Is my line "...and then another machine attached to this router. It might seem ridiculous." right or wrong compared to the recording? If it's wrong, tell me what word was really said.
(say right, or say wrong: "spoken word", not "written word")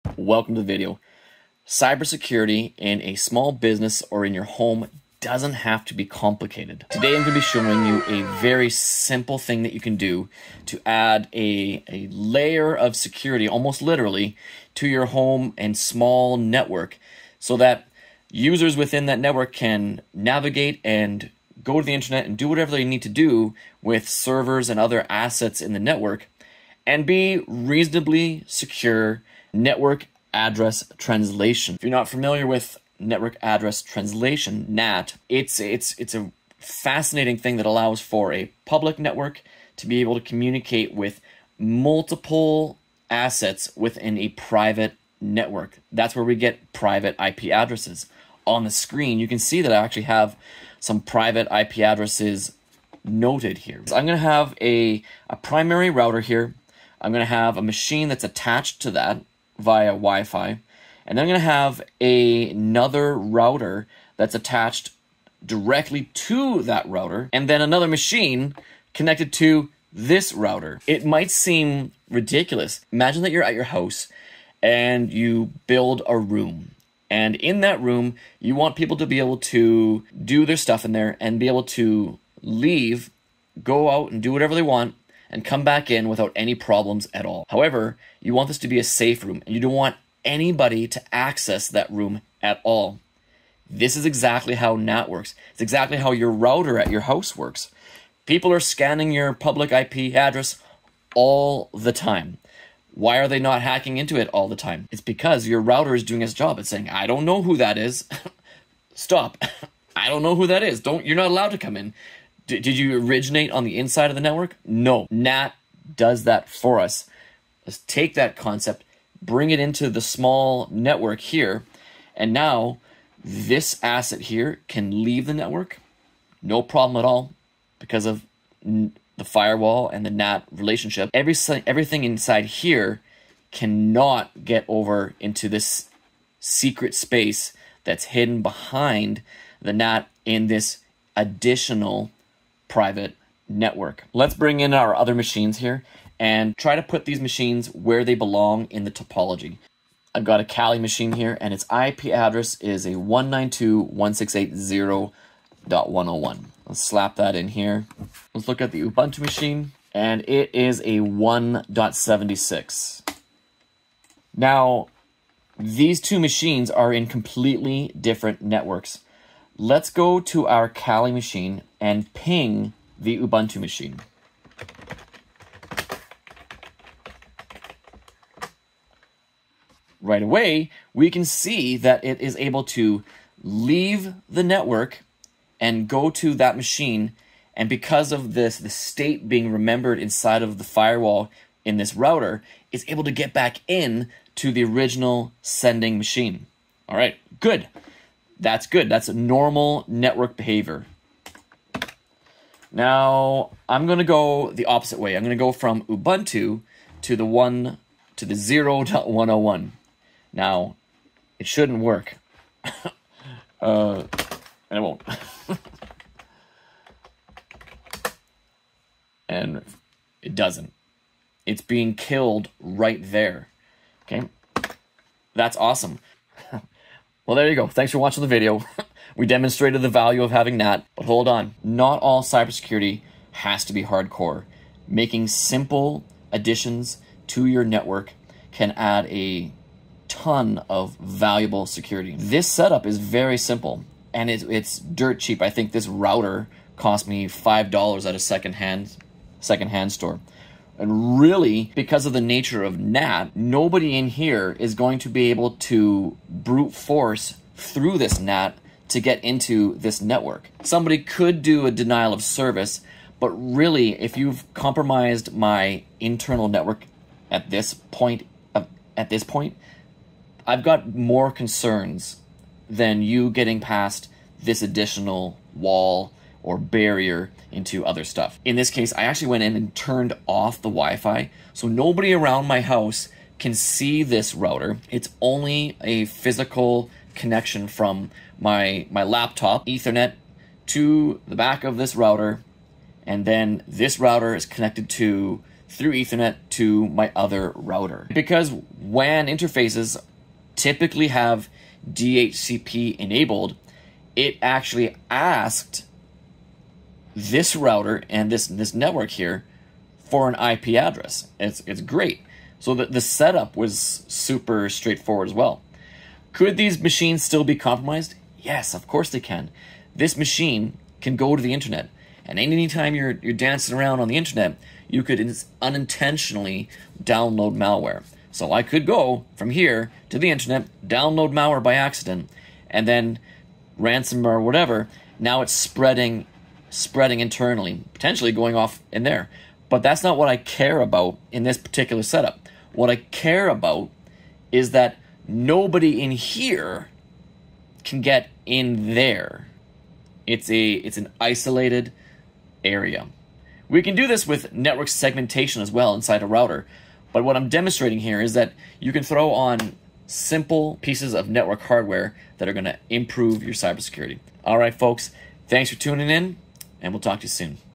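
wrong: "connected", not "attached".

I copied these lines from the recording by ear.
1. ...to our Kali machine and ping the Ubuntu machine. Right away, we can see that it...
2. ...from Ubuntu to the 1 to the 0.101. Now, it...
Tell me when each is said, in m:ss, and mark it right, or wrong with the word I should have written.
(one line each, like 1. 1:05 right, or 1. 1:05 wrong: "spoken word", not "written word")
1. 2:50 right
2. 3:25 right.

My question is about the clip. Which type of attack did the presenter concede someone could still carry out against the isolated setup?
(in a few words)
denial of service.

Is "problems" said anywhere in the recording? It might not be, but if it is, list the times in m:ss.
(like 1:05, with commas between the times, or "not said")
1:26, 2:06.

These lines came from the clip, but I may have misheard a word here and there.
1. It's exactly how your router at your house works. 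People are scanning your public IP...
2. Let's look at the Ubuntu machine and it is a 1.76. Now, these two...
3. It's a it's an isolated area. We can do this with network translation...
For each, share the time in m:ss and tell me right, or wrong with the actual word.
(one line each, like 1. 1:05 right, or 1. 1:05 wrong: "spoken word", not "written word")
1. 1:35 right
2. 2:38 right
3. 5:50 wrong: "segmentation", not "translation".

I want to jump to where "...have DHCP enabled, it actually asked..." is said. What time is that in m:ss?
5:01.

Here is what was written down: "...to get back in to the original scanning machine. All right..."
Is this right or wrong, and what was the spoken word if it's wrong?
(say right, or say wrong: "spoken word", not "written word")
wrong: "sending", not "scanning".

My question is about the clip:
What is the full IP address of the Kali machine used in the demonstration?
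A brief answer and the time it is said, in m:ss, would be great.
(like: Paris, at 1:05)
192.168.0.101, at 2:32.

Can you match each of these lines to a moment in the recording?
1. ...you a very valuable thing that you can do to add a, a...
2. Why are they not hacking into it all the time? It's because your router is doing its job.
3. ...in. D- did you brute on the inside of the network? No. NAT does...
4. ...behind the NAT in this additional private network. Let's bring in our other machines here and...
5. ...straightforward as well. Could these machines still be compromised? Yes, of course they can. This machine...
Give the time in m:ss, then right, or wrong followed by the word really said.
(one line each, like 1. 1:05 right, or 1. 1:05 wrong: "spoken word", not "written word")
1. 0:07 wrong: "simple", not "valuable"
2. 1:42 right
3. 1:51 wrong: "originate", not "brute"
4. 2:18 right
5. 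5:14 right.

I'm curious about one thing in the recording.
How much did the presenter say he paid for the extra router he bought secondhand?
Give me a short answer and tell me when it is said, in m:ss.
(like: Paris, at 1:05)
$5, at 4:07.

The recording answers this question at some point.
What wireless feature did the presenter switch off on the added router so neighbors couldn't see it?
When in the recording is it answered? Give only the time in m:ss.
4:40.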